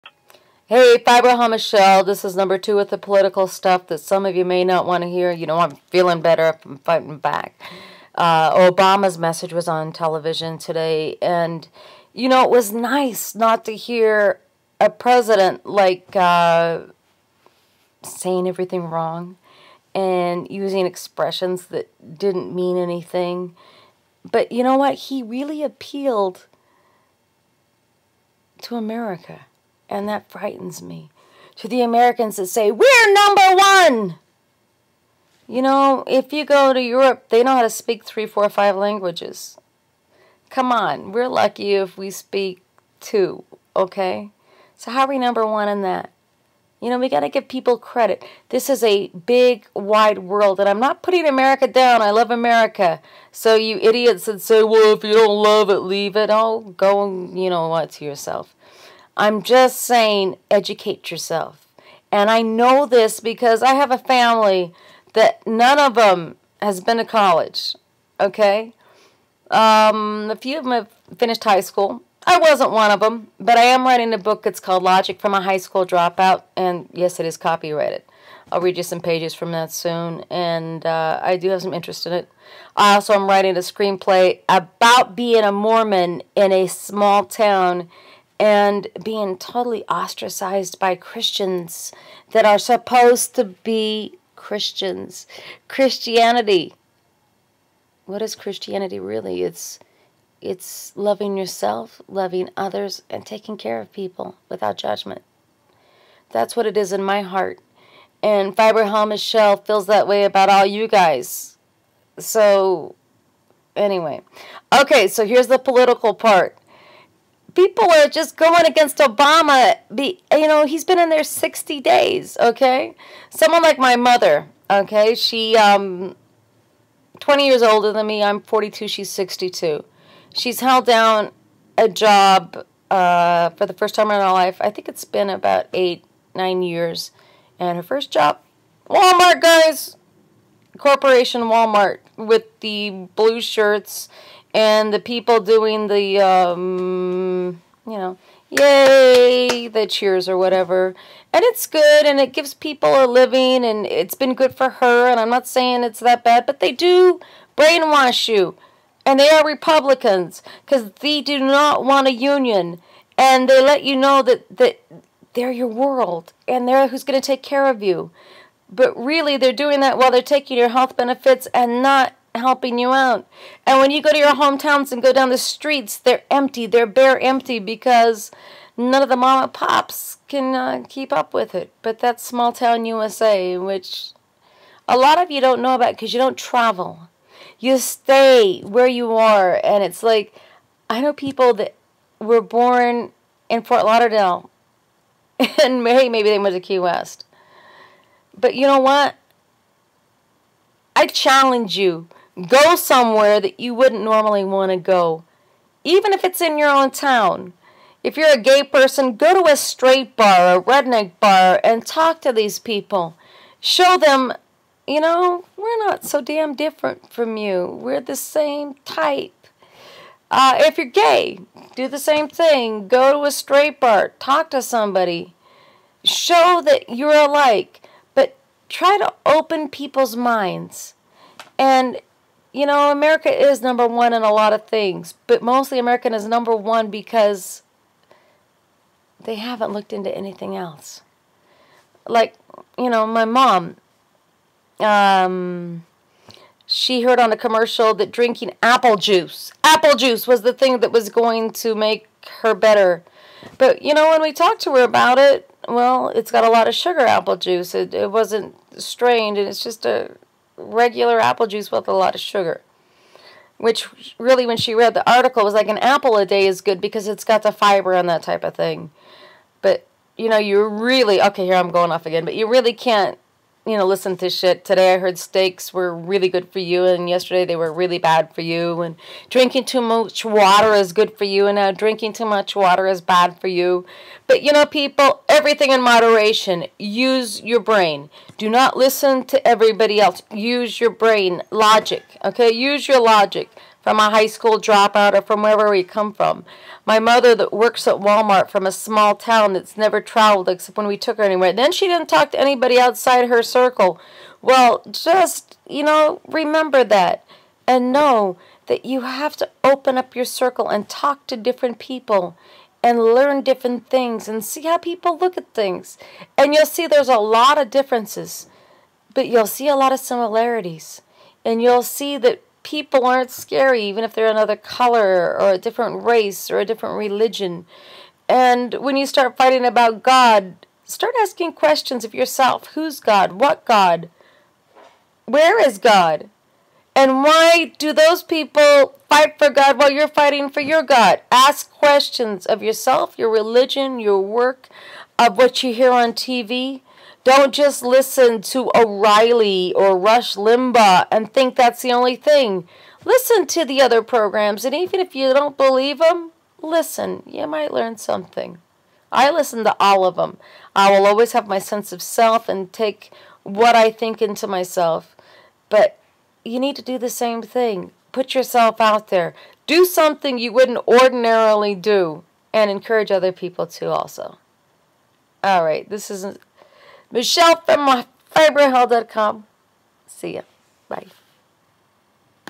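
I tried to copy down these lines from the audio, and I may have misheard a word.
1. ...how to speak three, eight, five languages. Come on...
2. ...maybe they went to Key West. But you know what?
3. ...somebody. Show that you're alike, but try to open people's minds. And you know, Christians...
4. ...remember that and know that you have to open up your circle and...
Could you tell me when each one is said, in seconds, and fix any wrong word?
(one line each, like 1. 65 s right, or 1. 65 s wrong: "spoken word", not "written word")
1. 37 s wrong: "four", not "eight"
2. 196 s right
3. 224 s wrong: "America", not "Christians"
4. 306 s right.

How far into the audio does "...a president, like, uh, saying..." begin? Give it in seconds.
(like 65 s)
14 s.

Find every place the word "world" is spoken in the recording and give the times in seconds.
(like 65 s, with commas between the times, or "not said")
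50 s, 165 s.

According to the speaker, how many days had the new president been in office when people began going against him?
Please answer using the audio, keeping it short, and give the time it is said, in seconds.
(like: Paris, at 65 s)
60, at 121 s.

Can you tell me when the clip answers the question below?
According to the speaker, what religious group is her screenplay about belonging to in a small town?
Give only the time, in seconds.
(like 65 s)
85 s.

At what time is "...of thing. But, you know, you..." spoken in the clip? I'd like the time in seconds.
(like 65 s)
268 s.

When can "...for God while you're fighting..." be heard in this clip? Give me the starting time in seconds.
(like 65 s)
339 s.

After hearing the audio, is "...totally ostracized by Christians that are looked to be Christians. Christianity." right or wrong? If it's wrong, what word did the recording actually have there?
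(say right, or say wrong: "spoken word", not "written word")
wrong: "supposed", not "looked".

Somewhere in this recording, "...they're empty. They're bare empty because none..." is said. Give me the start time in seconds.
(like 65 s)
175 s.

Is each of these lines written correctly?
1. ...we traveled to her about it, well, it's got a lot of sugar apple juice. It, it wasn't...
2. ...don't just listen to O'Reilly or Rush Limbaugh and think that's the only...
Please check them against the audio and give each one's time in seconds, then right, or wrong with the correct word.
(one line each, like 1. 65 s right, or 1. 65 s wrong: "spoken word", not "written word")
1. 254 s wrong: "talked", not "traveled"
2. 347 s right.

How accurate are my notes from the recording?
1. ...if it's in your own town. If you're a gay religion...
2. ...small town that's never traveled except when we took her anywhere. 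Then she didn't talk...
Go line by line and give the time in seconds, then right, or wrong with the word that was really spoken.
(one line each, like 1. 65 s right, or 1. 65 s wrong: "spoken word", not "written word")
1. 206 s wrong: "person", not "religion"
2. 298 s right.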